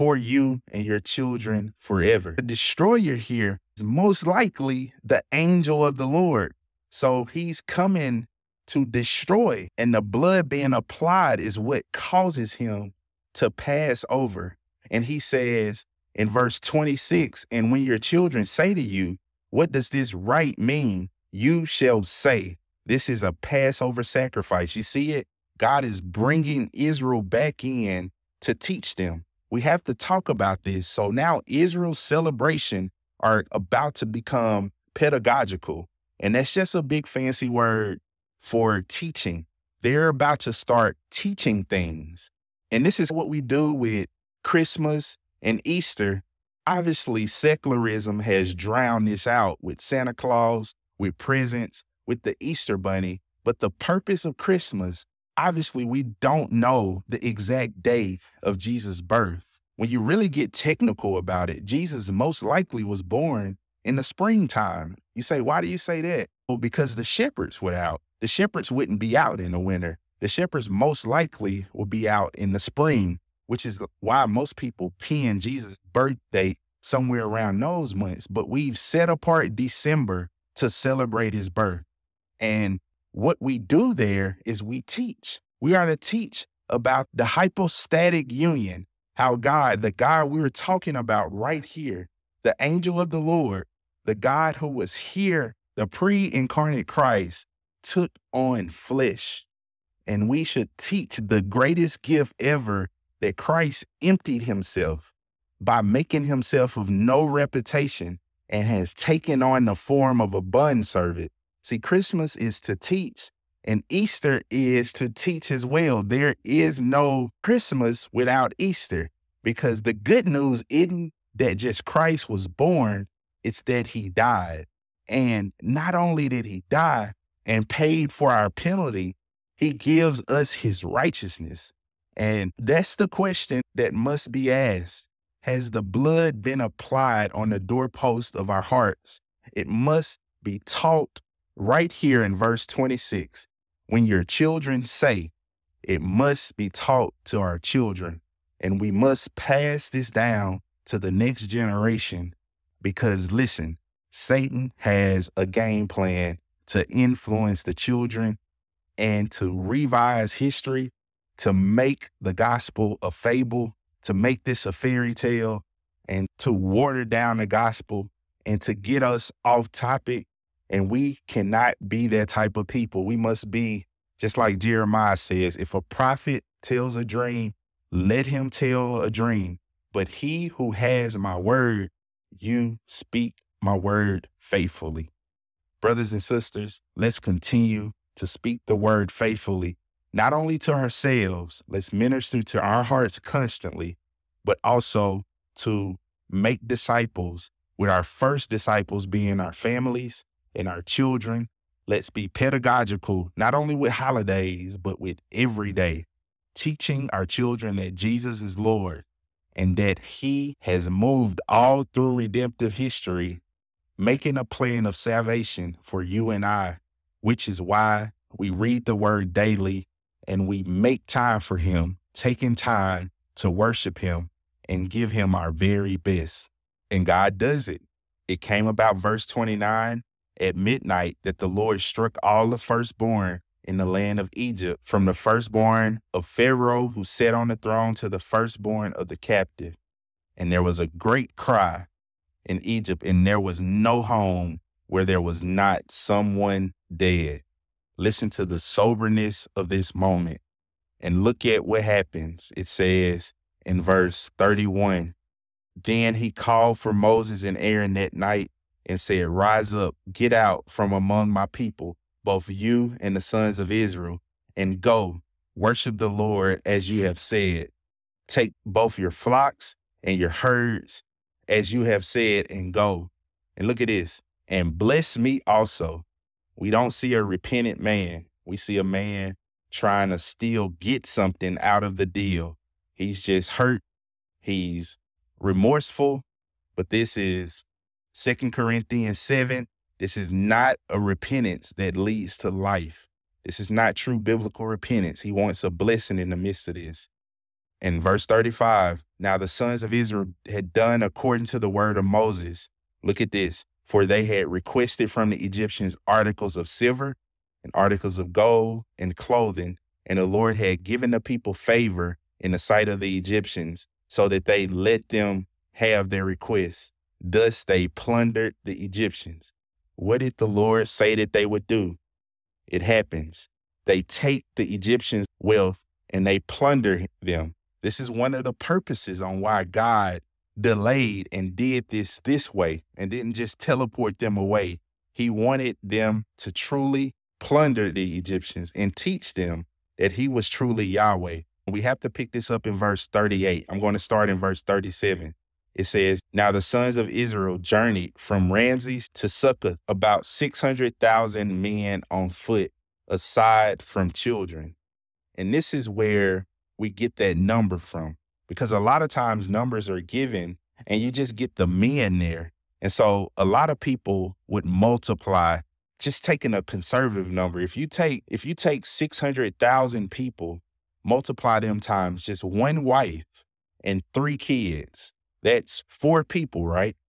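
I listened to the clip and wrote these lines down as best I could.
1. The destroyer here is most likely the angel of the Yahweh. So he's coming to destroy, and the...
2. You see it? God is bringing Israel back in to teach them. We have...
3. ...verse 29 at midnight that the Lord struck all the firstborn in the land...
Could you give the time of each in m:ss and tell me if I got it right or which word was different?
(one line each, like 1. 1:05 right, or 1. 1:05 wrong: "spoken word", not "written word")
1. 0:02 wrong: "Lord", not "Yahweh"
2. 0:24 right
3. 3:48 right.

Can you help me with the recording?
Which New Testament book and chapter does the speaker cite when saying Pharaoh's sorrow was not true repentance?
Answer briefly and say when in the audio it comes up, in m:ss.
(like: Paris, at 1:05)
Second Corinthians 7, at 4:48.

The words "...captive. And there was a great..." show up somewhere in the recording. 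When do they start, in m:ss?
3:59.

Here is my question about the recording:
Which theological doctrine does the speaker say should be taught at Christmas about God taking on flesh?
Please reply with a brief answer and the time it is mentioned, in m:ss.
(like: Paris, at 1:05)
Hypostatic union, at 1:27.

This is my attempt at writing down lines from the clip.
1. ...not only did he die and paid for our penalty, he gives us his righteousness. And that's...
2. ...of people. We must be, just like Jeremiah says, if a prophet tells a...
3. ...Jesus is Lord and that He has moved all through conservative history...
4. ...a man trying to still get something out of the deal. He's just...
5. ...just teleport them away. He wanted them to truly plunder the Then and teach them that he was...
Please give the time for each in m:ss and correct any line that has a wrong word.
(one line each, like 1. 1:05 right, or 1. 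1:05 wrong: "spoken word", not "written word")
1. 2:05 right
2. 2:52 right
3. 3:27 wrong: "redemptive", not "conservative"
4. 4:38 right
5. 5:33 wrong: "Egyptians", not "Then".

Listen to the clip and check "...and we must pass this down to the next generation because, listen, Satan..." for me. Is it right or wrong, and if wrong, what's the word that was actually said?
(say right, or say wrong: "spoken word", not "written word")
right.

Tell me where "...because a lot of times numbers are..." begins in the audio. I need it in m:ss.
5:58.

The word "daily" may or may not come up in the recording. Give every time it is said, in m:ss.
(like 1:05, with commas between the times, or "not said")
3:39.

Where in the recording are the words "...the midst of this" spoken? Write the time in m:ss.
4:56.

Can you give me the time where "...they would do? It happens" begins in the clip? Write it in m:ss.
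5:21.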